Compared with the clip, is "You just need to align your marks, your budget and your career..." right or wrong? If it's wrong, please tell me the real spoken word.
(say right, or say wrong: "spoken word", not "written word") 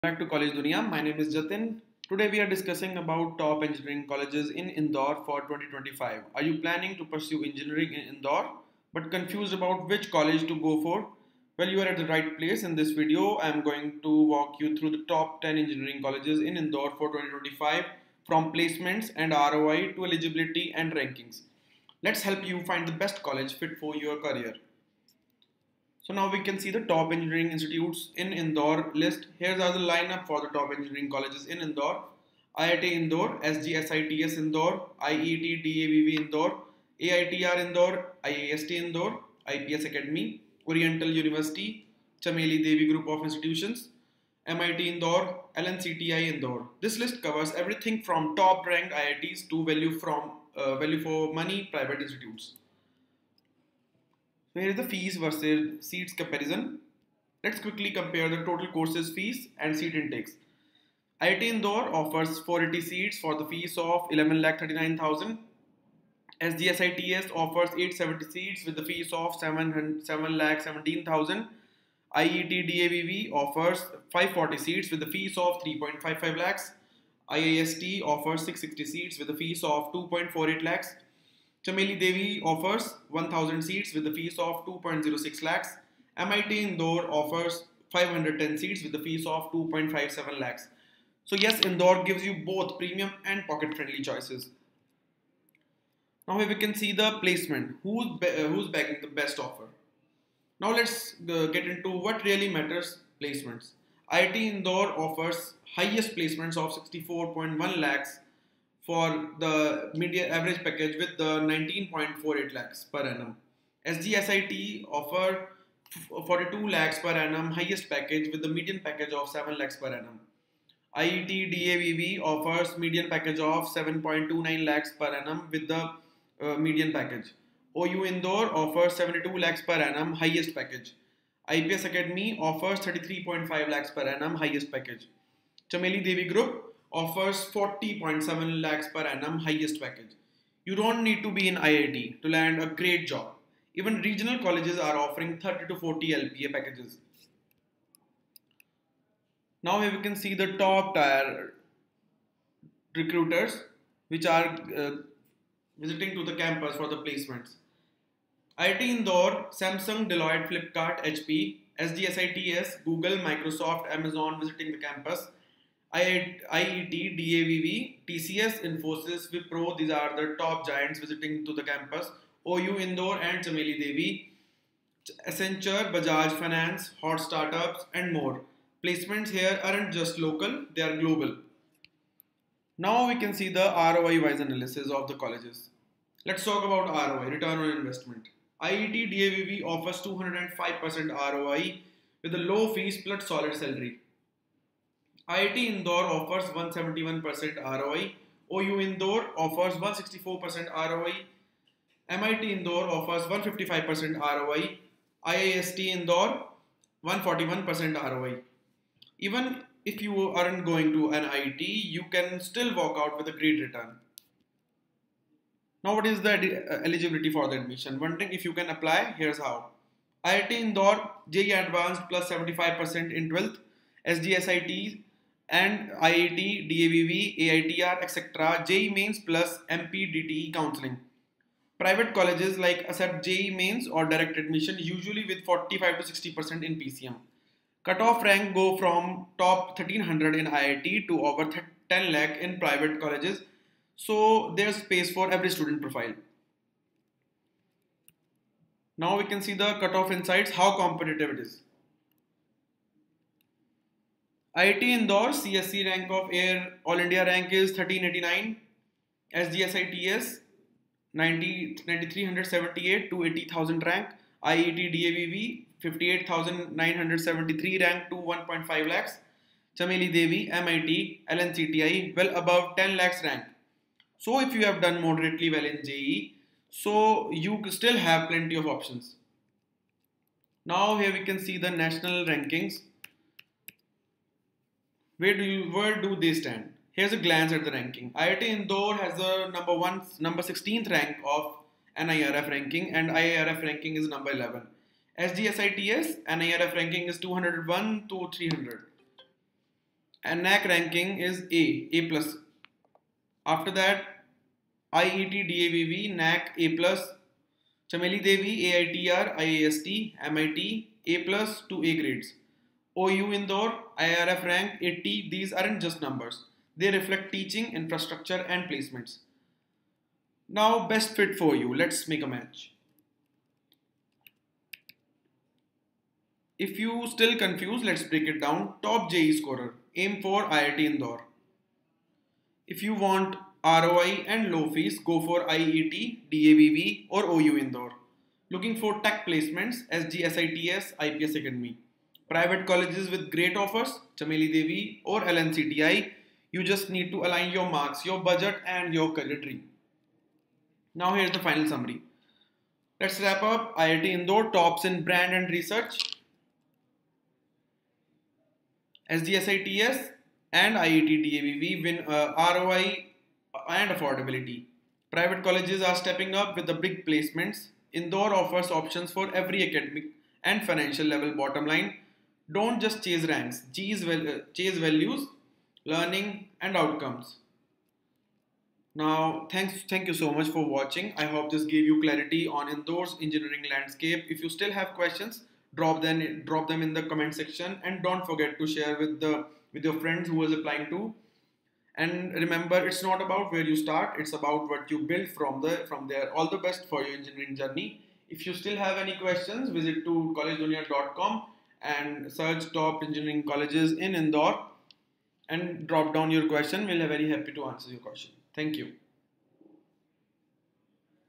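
right.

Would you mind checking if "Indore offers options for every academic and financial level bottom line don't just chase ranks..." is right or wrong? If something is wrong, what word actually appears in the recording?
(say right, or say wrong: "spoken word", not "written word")
right.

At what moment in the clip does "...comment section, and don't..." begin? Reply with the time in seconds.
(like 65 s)
387 s.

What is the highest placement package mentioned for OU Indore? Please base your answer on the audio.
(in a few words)
72 lakhs per annum.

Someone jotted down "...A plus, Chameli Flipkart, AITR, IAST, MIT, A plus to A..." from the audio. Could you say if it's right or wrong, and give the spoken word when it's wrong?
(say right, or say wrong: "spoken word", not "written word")
wrong: "Devi", not "Flipkart".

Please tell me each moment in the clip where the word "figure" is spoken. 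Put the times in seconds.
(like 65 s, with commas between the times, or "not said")
not said.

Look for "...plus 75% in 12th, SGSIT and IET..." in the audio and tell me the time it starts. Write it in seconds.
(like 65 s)
222 s.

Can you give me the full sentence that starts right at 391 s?
And remember, it's not about where you start; it's about what you build from the from there.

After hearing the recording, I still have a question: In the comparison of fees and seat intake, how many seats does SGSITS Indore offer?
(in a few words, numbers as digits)
870.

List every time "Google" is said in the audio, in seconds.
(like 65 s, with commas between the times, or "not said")
162 s.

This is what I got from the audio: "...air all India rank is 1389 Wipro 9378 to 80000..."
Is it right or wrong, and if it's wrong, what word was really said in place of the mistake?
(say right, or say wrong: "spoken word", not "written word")
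wrong: "SGSITS", not "Wipro".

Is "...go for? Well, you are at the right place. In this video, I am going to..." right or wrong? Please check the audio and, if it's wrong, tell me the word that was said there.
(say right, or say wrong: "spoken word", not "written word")
right.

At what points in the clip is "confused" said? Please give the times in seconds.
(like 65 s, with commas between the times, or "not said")
9 s, 327 s.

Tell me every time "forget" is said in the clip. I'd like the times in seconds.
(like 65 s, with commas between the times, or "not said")
388 s.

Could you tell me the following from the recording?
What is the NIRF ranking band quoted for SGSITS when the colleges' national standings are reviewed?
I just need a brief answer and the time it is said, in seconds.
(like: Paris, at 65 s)
201 to 300, at 297 s.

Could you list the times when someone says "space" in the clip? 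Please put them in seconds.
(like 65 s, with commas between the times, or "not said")
244 s.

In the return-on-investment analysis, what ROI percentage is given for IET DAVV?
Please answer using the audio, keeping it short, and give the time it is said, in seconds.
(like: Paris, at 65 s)
205%, at 189 s.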